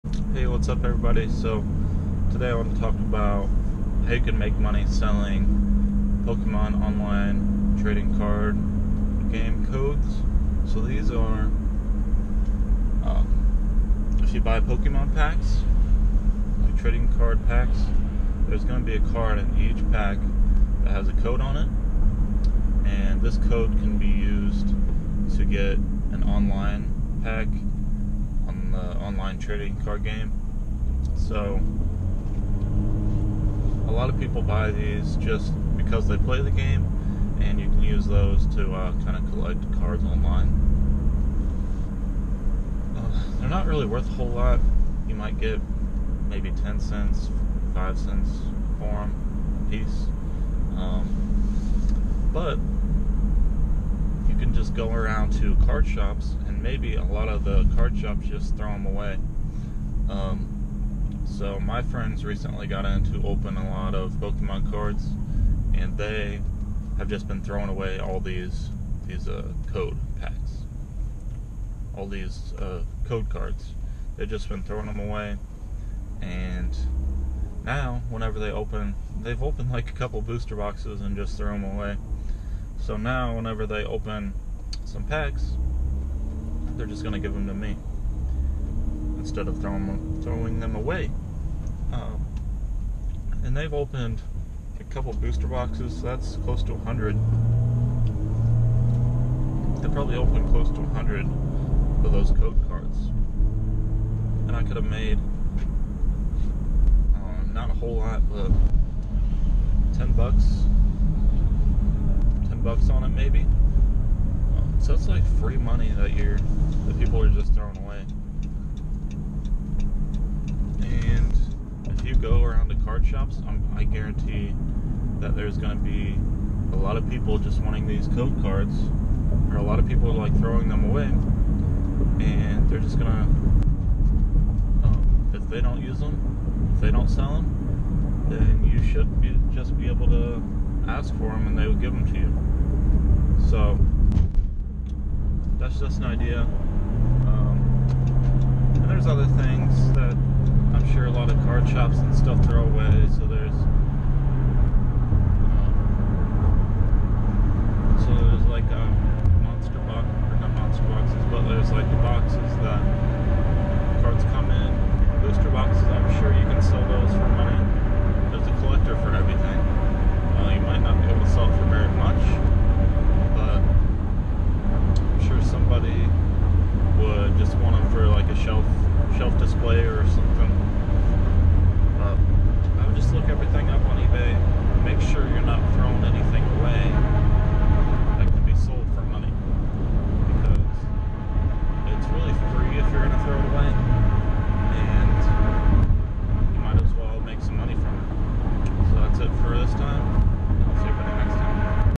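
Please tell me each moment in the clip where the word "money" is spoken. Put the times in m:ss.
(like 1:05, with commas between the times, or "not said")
0:04, 1:55.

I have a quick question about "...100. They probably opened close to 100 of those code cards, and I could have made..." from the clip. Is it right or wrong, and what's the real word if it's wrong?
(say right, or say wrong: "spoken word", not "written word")
right.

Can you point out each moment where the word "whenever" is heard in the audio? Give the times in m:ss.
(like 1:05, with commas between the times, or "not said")
1:18, 1:23.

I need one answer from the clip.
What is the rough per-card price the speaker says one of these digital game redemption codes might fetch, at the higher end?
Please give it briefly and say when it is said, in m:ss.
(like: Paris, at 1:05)
10 cents, at 0:46.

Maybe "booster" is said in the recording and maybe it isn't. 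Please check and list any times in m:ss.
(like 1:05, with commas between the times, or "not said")
1:20, 1:35.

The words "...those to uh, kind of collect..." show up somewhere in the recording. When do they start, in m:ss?
0:38.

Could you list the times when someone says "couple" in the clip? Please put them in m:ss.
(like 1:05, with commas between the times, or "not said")
1:19, 1:34.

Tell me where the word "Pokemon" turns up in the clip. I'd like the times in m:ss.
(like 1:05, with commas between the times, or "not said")
0:06, 0:14, 1:04.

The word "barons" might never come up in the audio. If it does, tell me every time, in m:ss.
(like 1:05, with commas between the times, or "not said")
not said.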